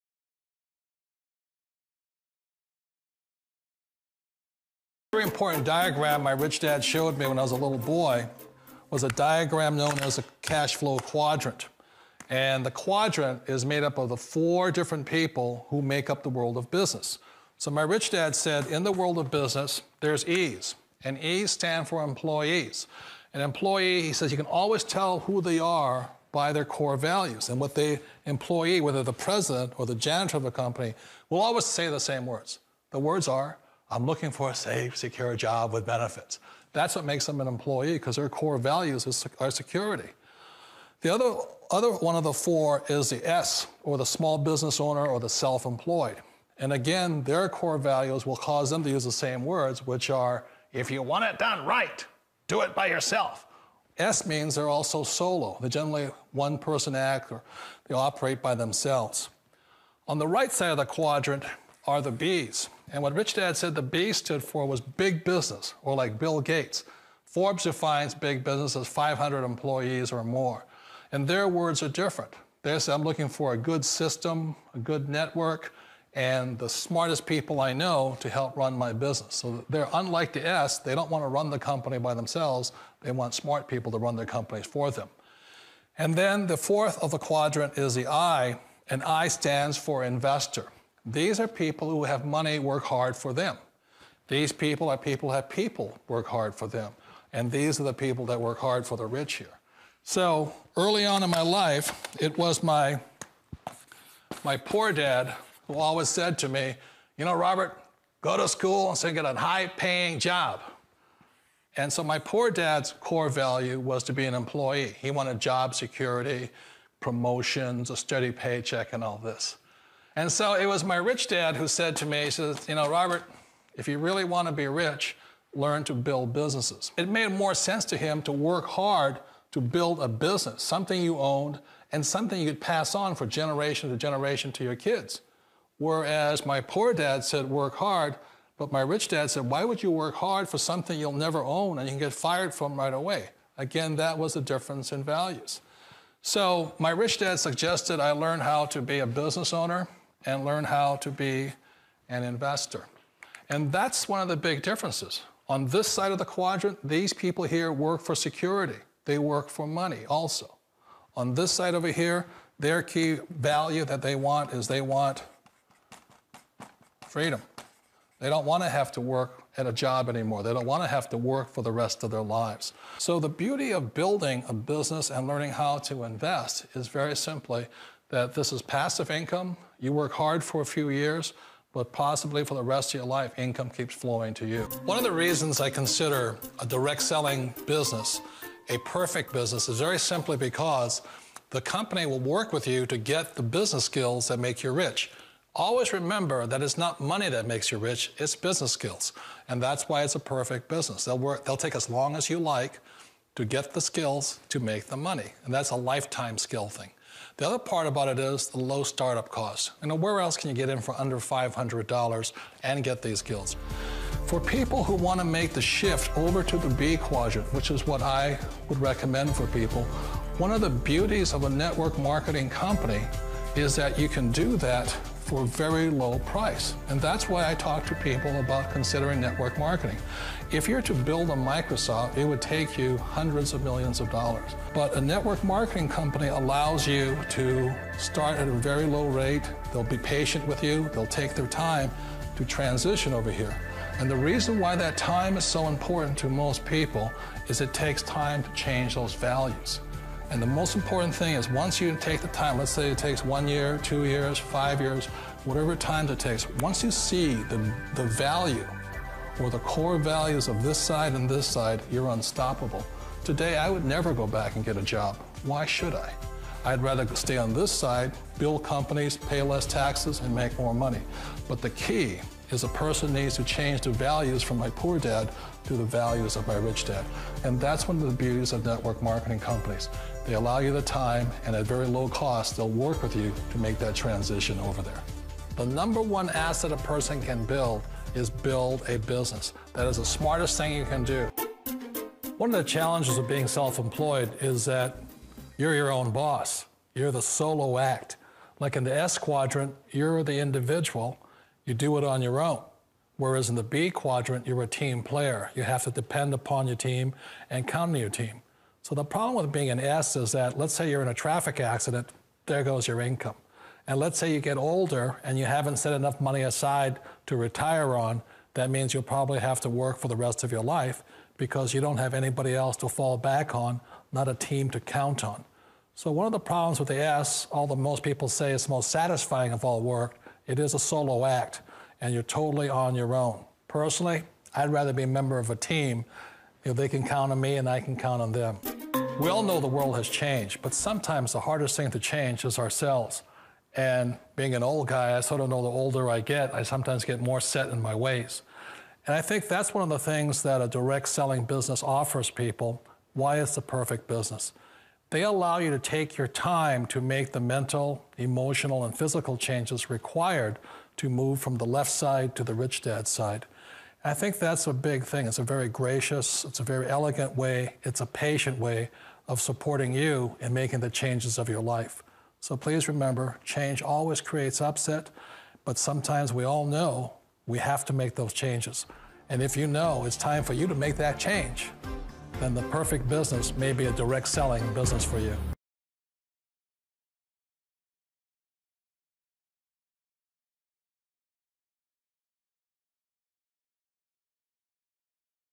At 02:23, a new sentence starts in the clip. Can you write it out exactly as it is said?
Again, that was the difference in values.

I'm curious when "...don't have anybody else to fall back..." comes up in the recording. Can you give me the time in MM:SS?
05:21.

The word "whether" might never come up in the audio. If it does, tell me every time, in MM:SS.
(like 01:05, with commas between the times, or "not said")
00:28.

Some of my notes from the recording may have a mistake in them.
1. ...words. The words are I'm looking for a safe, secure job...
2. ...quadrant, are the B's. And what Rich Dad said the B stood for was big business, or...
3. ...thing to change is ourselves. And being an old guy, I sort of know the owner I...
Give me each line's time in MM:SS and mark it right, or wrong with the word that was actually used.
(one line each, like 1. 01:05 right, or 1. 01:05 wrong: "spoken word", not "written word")
1. 00:32 right
2. 01:00 right
3. 05:41 wrong: "older", not "owner".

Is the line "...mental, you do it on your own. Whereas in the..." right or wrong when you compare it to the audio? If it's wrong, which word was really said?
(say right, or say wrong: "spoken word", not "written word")
wrong: "individual", not "mental".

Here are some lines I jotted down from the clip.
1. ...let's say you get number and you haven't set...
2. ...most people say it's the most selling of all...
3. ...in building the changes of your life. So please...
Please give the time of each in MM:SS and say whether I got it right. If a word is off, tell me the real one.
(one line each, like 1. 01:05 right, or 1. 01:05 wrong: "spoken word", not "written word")
1. 05:13 wrong: "older", not "number"
2. 05:27 wrong: "satisfying", not "selling"
3. 06:10 wrong: "making", not "building".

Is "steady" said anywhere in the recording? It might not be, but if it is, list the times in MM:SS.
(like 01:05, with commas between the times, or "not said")
01:57.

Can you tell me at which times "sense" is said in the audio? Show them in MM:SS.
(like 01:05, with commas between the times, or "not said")
02:07.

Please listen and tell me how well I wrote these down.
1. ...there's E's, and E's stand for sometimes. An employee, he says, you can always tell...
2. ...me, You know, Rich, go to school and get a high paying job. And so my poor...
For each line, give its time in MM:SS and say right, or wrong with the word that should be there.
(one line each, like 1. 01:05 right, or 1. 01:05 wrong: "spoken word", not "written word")
1. 00:19 wrong: "employees", not "sometimes"
2. 01:46 wrong: "Robert", not "Rich".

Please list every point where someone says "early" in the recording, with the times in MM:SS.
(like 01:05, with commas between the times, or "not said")
01:40.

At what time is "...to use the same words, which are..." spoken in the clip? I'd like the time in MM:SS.
00:48.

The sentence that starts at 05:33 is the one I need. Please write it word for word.
Personally, I'd rather be a member of a team.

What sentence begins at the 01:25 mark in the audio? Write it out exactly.
And then the fourth of the quadrant is the I, and I stands for investor.